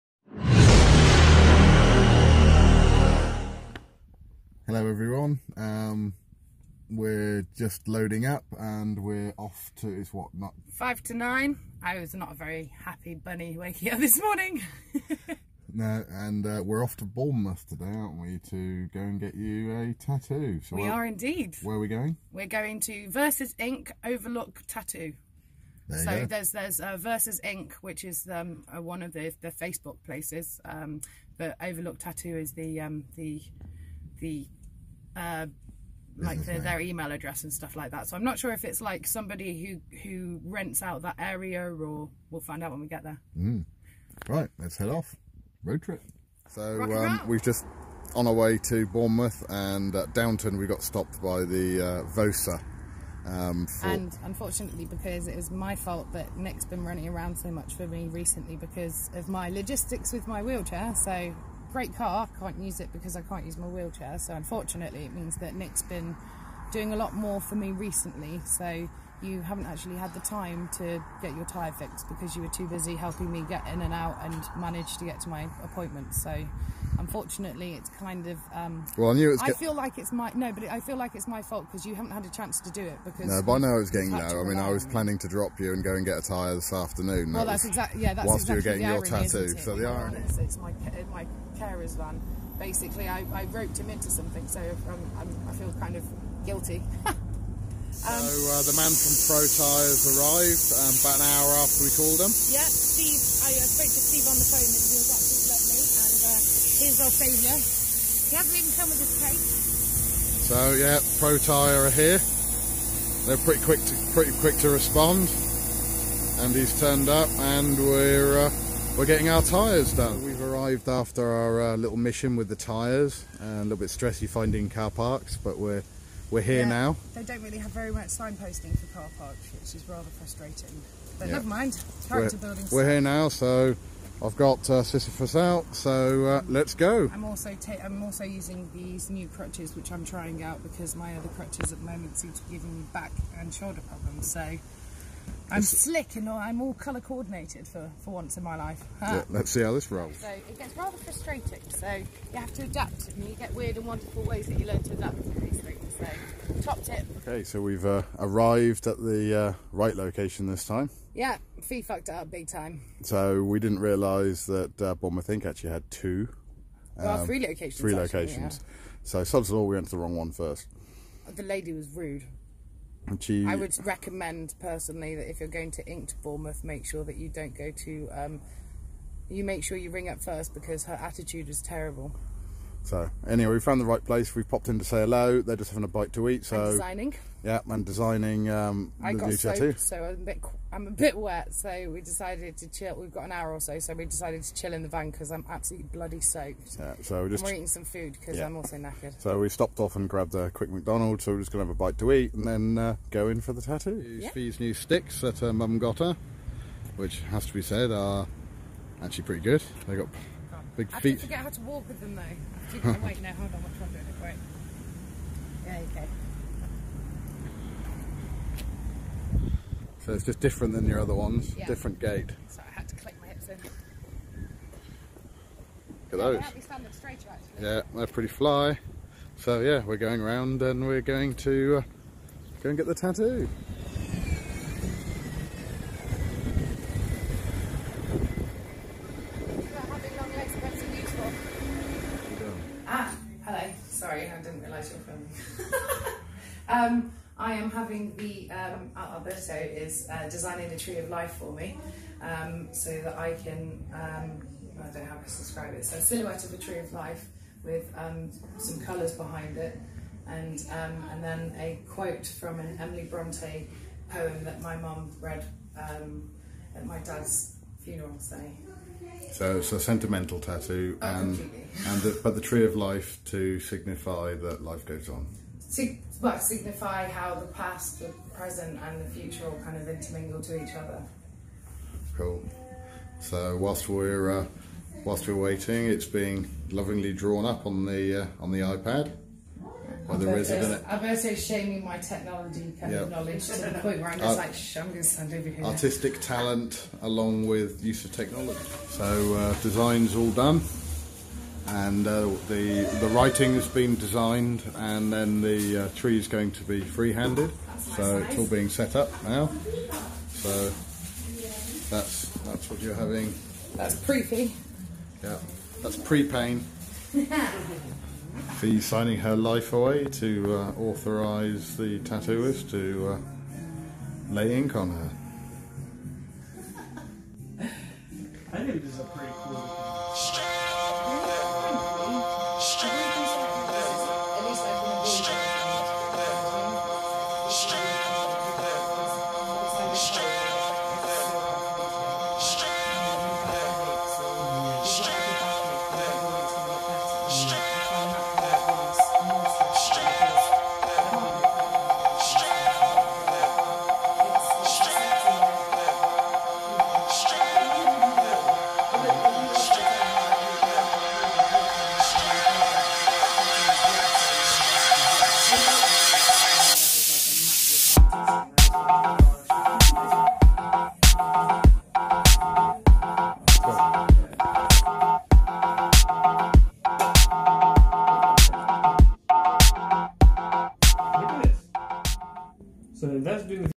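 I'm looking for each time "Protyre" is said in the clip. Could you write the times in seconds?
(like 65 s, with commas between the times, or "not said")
111 s.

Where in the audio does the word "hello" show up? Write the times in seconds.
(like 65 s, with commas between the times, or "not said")
4 s, 185 s.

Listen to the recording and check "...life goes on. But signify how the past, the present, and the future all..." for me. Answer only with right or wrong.
right.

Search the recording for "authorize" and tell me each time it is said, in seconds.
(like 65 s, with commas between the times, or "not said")
320 s.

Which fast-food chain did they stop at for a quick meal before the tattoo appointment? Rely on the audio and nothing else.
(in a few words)
McDonald's.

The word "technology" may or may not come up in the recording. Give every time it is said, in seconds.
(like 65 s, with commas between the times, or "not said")
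291 s, 298 s.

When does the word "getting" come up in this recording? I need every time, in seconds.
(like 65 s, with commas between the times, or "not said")
83 s, 89 s, 119 s.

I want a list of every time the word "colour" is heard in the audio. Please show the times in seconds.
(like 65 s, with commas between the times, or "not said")
146 s, 258 s.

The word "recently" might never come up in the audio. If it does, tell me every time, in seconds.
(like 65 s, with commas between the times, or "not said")
58 s, 67 s.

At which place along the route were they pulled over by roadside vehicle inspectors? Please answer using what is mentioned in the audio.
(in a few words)
Downton.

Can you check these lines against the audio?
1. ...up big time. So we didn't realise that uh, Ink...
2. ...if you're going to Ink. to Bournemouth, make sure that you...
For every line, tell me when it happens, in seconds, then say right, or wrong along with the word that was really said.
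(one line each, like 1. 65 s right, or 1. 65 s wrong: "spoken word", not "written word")
1. 162 s wrong: "Bournemouth", not "Ink"
2. 175 s right.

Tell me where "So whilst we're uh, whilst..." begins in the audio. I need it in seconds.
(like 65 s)
283 s.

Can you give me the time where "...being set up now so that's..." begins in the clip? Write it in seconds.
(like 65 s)
308 s.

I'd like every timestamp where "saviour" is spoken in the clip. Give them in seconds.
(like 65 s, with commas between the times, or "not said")
107 s.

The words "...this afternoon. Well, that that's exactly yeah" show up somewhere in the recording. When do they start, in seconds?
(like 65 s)
86 s.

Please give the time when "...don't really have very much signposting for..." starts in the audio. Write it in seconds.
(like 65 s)
127 s.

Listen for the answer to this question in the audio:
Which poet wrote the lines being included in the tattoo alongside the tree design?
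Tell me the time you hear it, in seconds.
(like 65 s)
262 s.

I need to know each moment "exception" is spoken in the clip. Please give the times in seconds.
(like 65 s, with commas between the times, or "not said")
not said.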